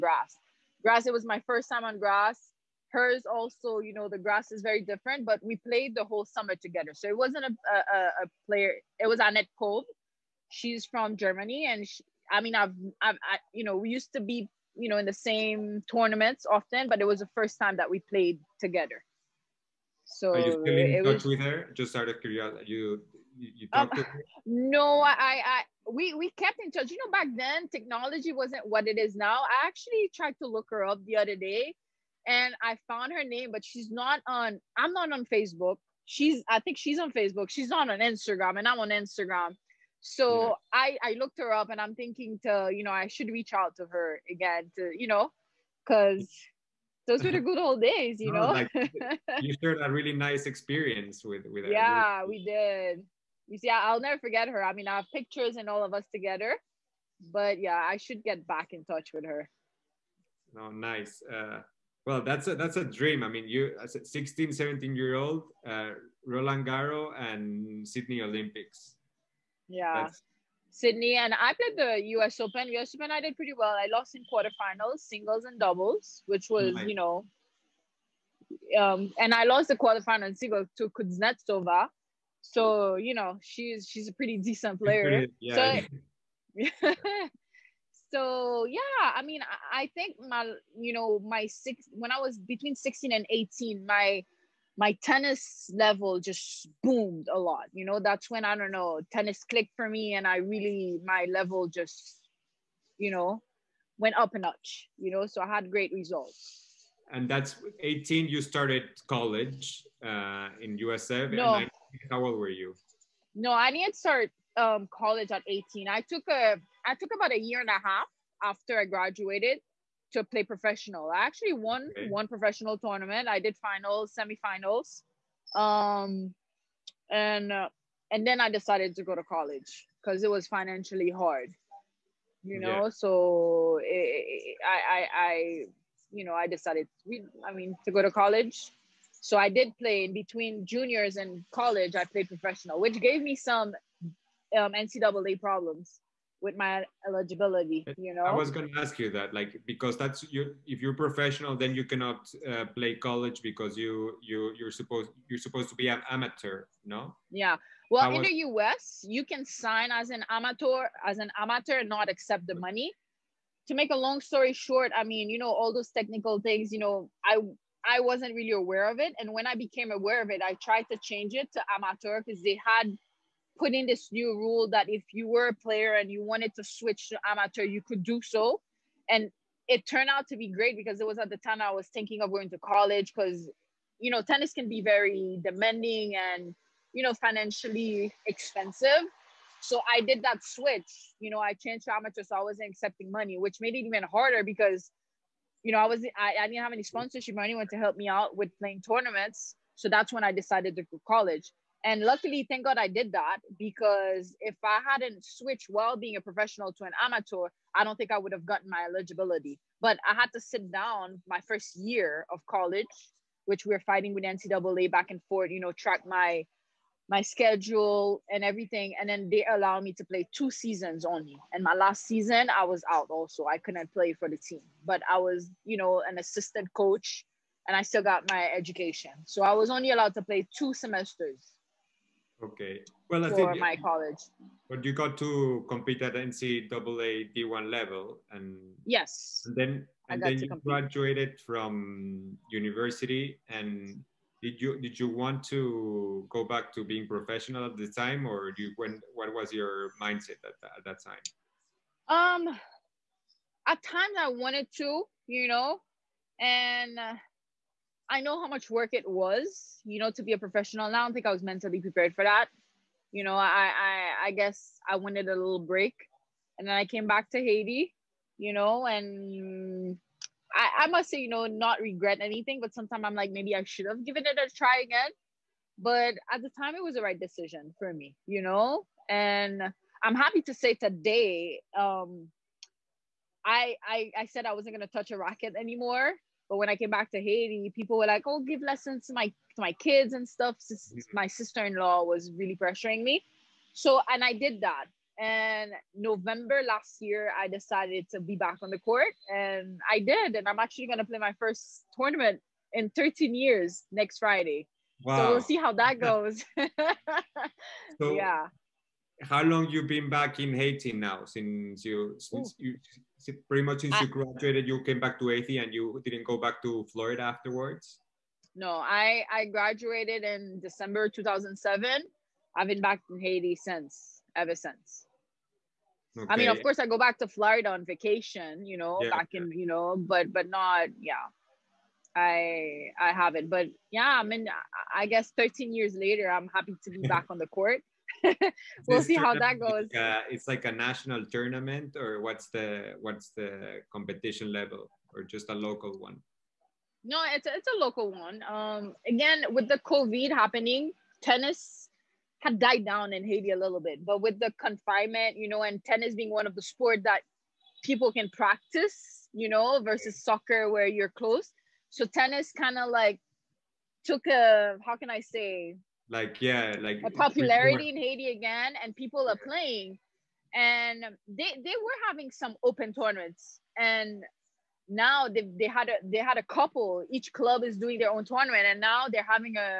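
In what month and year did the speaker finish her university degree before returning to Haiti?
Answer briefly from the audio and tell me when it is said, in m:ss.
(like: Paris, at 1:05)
December 2007, at 5:20.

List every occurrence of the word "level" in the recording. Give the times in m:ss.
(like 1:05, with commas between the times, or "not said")
1:35, 1:41, 3:57, 5:44.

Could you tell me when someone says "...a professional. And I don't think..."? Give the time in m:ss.
4:20.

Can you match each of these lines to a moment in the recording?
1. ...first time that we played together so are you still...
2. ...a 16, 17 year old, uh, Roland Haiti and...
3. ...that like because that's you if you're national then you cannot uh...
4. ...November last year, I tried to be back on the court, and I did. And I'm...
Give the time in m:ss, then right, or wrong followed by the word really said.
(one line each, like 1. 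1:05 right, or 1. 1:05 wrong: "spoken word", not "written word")
1. 0:17 right
2. 1:03 wrong: "Garros", not "Haiti"
3. 2:29 wrong: "professional", not "national"
4. 4:55 wrong: "decided", not "tried".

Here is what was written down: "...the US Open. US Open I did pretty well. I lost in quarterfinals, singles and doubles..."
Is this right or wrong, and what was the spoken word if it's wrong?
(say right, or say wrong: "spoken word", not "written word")
right.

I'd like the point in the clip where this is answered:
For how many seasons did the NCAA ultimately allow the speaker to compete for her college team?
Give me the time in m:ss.
3:40.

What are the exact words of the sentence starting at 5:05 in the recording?
So we'll see how that goes.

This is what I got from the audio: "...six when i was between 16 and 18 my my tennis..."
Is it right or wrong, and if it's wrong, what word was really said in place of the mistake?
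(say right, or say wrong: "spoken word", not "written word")
right.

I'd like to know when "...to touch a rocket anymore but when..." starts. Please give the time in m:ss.
4:44.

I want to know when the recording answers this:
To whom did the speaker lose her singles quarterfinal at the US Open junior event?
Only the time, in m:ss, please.
1:20.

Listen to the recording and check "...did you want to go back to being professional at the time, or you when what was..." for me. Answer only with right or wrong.
right.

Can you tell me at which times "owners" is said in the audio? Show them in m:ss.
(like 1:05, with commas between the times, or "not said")
not said.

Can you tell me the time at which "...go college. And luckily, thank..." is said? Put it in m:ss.
3:20.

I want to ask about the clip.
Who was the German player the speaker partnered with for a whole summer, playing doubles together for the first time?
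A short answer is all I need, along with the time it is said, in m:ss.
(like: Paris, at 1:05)
Annette Kolb, at 0:09.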